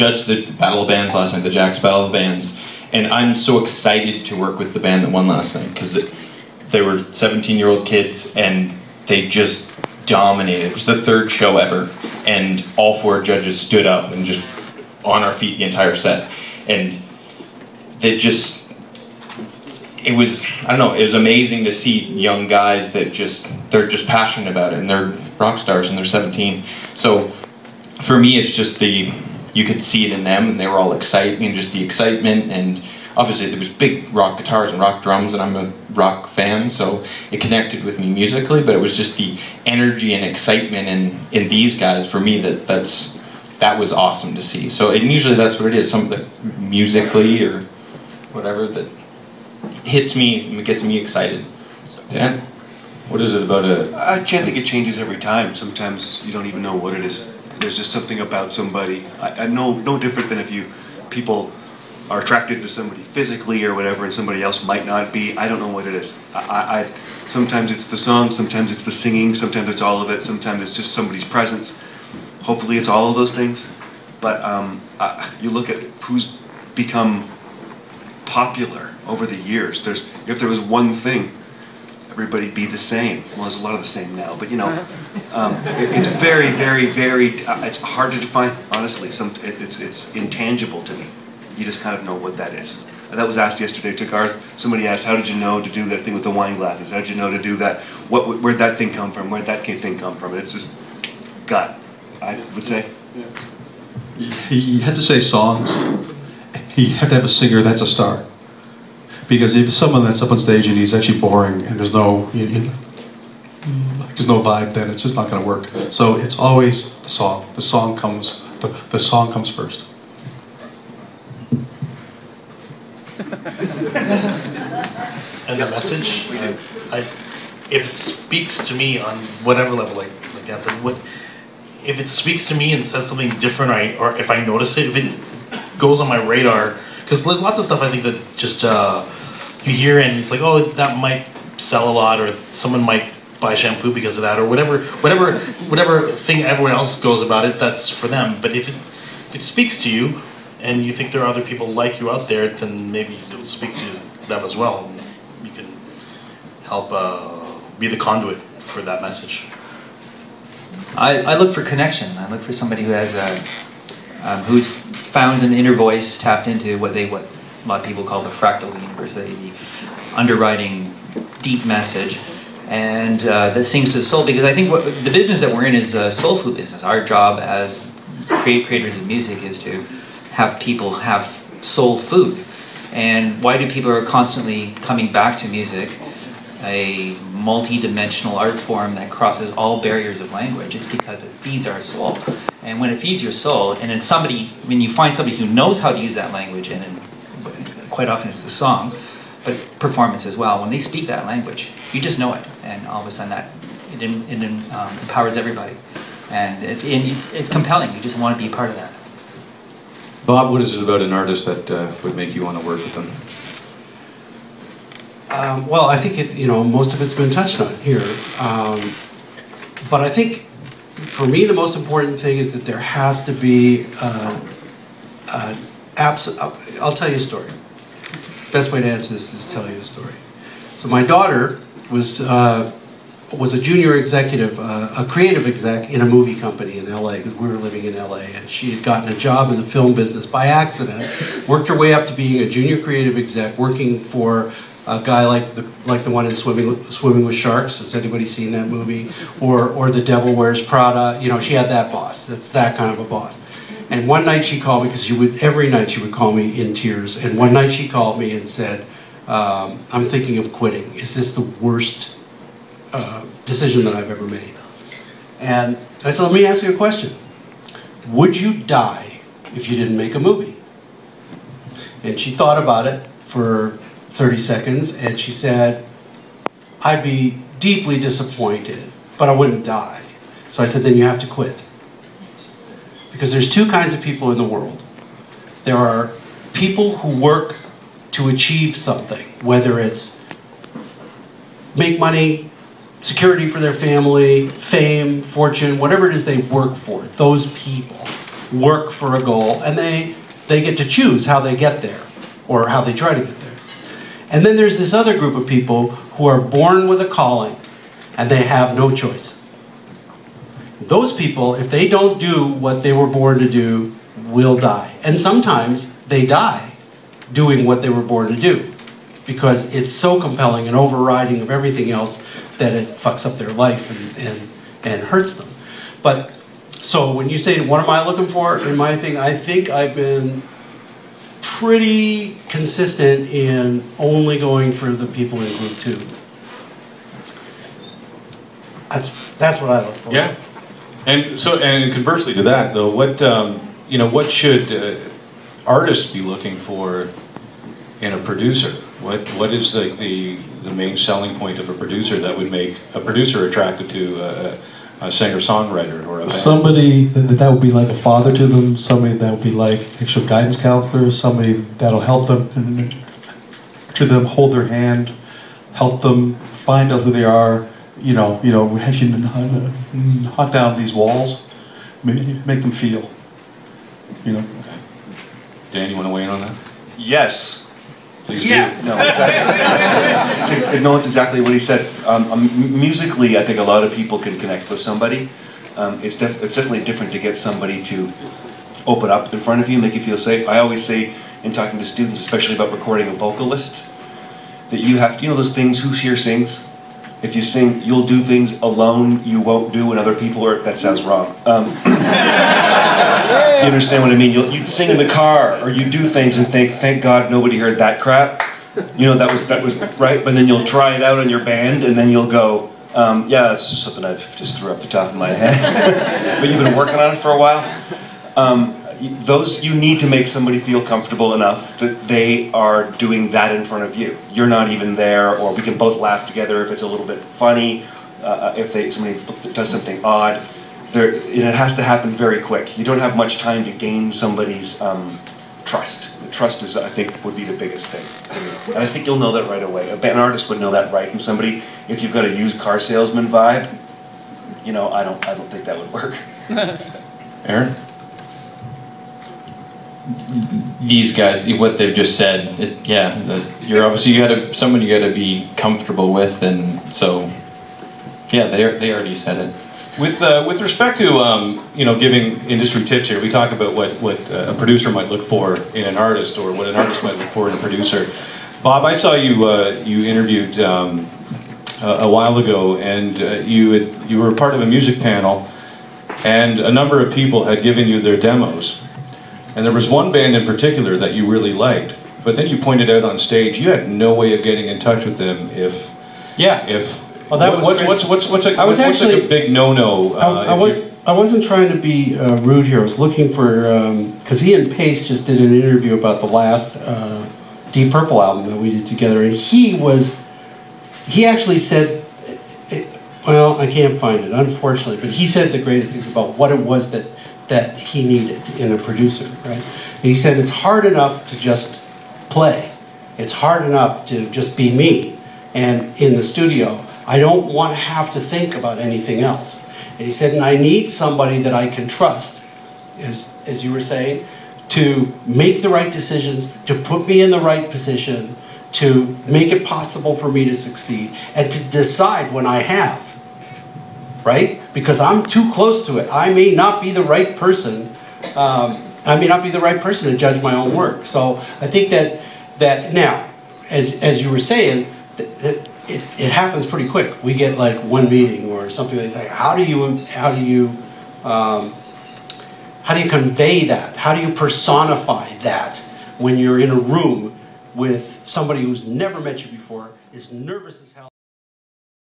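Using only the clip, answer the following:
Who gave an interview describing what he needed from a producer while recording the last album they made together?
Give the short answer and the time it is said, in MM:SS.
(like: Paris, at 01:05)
Ian Paice, at 08:14.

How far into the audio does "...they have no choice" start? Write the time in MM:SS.
05:08.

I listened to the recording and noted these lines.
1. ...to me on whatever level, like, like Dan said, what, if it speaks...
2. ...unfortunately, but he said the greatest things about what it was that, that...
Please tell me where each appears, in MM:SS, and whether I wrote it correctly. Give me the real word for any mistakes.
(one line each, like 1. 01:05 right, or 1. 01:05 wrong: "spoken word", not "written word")
1. 02:08 right
2. 08:24 right.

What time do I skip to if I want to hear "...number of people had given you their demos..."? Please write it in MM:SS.
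07:56.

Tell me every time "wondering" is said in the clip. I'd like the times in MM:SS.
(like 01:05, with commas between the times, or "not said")
not said.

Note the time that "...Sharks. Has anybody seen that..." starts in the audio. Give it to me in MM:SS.
04:07.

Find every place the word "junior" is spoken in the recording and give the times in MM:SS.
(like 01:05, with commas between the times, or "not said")
03:53, 04:02.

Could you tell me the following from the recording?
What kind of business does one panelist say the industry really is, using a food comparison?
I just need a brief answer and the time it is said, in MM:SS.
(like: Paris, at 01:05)
Soul food business, at 02:56.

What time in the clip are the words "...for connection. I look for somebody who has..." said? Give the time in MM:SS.
02:41.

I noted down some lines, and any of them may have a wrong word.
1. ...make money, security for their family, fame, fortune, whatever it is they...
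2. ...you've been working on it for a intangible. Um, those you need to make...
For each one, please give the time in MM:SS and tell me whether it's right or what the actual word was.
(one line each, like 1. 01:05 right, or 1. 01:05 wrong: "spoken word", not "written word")
1. 04:51 right
2. 06:56 wrong: "while", not "intangible".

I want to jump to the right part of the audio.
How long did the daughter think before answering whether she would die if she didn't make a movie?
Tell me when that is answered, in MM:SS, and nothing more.
04:34.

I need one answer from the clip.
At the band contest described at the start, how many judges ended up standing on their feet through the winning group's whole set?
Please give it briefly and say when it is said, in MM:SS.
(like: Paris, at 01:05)
4, at 00:12.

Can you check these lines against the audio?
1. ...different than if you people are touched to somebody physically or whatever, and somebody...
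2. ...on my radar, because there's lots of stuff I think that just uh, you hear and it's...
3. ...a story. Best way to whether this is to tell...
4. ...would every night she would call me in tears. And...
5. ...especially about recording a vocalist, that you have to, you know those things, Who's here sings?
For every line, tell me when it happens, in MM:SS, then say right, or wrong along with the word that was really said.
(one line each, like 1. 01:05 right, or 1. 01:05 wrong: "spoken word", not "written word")
1. 00:59 wrong: "attracted", not "touched"
2. 02:15 right
3. 03:47 wrong: "answer", not "whether"
4. 04:15 right
5. 06:32 right.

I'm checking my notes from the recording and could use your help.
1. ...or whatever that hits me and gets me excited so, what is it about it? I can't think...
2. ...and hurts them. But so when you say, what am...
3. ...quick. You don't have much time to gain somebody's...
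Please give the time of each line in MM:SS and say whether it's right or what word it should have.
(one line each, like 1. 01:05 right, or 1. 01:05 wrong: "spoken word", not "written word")
1. 00:47 right
2. 05:24 right
3. 07:12 right.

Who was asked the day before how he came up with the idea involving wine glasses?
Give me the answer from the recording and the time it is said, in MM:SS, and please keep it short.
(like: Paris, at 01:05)
Garth, at 01:34.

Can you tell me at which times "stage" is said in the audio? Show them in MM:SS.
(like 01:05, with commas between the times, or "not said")
01:50, 08:03.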